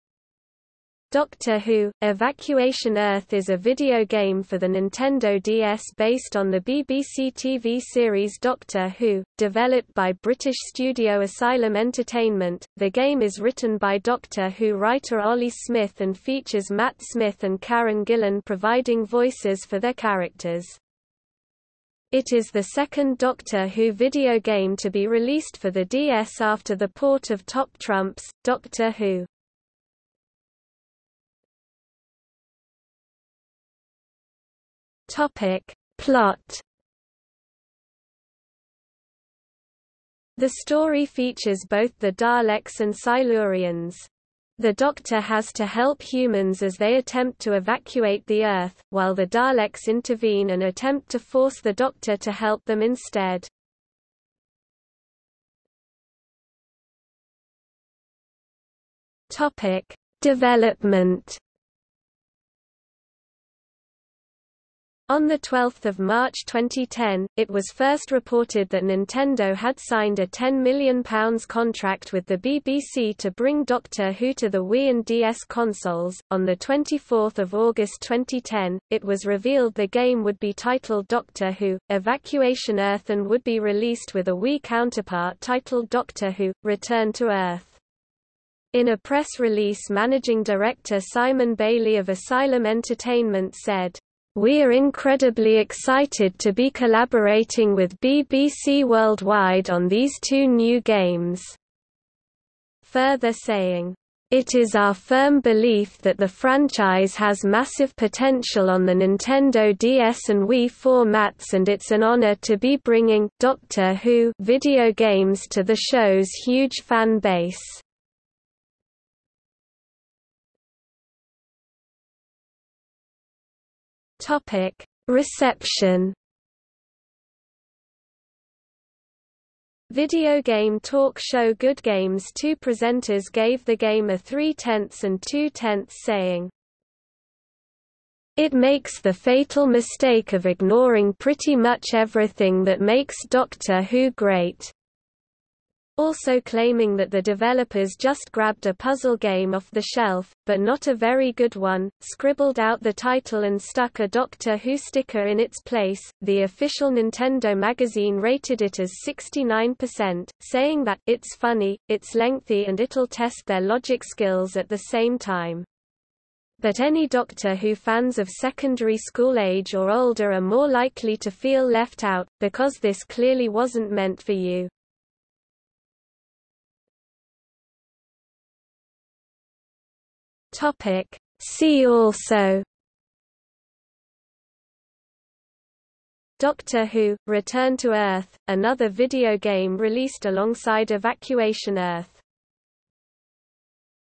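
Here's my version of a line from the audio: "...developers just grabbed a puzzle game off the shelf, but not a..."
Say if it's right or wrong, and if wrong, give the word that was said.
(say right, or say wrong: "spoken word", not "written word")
right.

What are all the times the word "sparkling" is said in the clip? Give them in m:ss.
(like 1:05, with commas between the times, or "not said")
not said.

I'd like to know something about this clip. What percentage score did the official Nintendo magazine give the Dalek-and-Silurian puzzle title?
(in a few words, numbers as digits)
69%.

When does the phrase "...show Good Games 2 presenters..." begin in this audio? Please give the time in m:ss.
2:11.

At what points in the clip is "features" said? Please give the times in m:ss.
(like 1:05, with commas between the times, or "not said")
0:16, 0:41.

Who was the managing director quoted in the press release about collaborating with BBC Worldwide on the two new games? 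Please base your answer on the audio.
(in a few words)
Simon Bailey.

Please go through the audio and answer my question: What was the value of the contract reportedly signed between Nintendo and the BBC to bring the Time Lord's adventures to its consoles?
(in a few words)
£10 million.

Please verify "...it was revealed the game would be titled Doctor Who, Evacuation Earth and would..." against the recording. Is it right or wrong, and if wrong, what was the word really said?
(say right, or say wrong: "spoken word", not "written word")
right.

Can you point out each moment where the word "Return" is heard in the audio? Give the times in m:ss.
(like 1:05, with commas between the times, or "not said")
1:26, 3:07.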